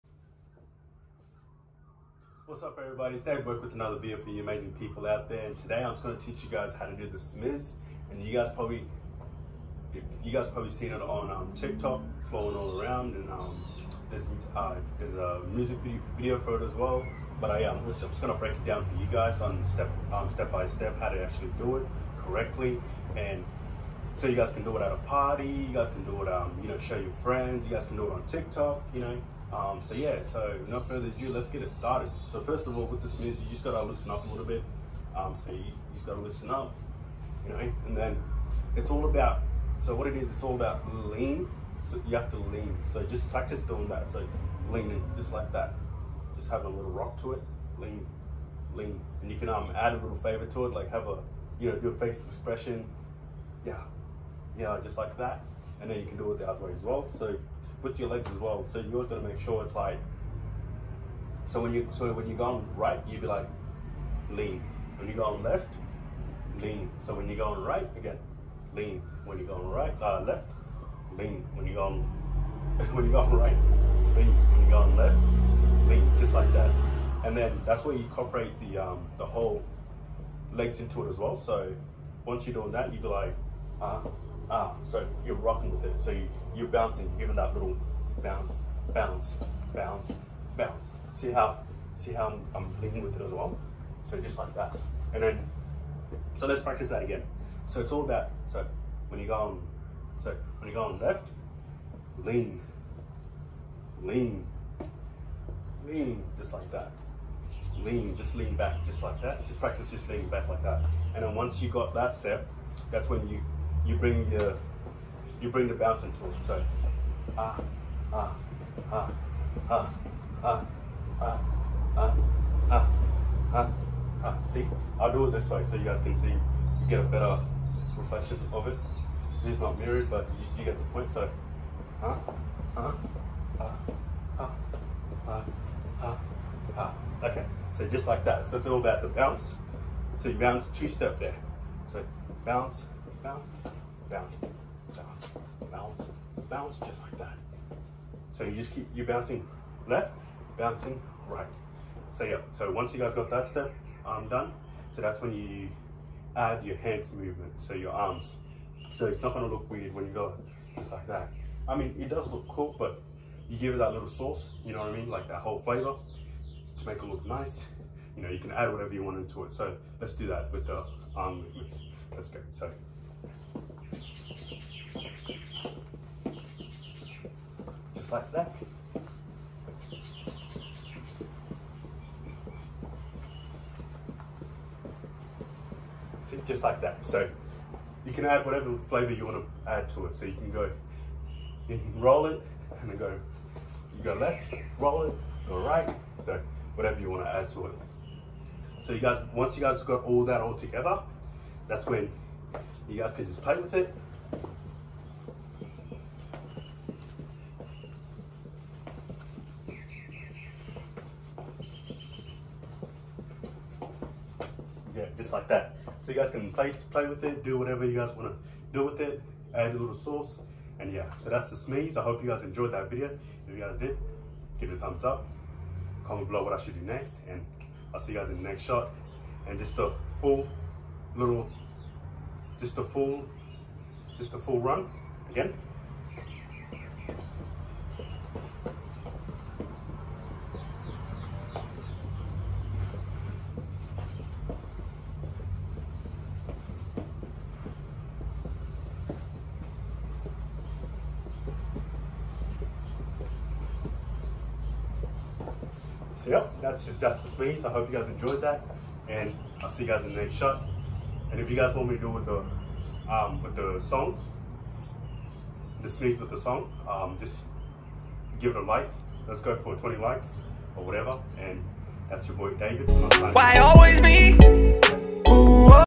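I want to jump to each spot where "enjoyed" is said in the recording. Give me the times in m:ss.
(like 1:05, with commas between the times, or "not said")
3:42, 4:18.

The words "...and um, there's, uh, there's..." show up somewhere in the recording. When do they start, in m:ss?
0:13.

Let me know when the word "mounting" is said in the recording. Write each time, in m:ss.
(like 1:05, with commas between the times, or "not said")
not said.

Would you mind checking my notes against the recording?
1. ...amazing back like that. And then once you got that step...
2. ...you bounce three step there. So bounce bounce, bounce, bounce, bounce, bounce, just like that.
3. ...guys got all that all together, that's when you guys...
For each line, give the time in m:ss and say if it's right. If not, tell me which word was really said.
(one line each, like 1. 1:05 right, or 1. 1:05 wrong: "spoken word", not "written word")
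1. 1:50 wrong: "leaning", not "amazing"
2. 2:20 wrong: "two", not "three"
3. 3:19 right.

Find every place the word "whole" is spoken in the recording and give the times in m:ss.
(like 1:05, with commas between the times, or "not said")
1:19, 2:45.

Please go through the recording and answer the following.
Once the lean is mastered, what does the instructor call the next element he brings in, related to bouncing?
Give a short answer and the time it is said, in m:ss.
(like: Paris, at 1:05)
bouncing tool, at 1:55.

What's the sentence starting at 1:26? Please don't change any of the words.
So you, you're bouncing, you're giving that little bounce, bounce, bounce, bounce.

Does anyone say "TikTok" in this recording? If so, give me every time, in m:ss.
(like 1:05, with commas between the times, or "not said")
0:11, 0:28.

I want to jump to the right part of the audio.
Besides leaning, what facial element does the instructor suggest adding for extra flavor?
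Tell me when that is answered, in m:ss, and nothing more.
0:51.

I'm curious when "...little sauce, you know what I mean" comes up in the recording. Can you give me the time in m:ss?
2:43.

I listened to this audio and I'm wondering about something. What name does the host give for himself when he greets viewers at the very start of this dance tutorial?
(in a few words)
Dave Wek.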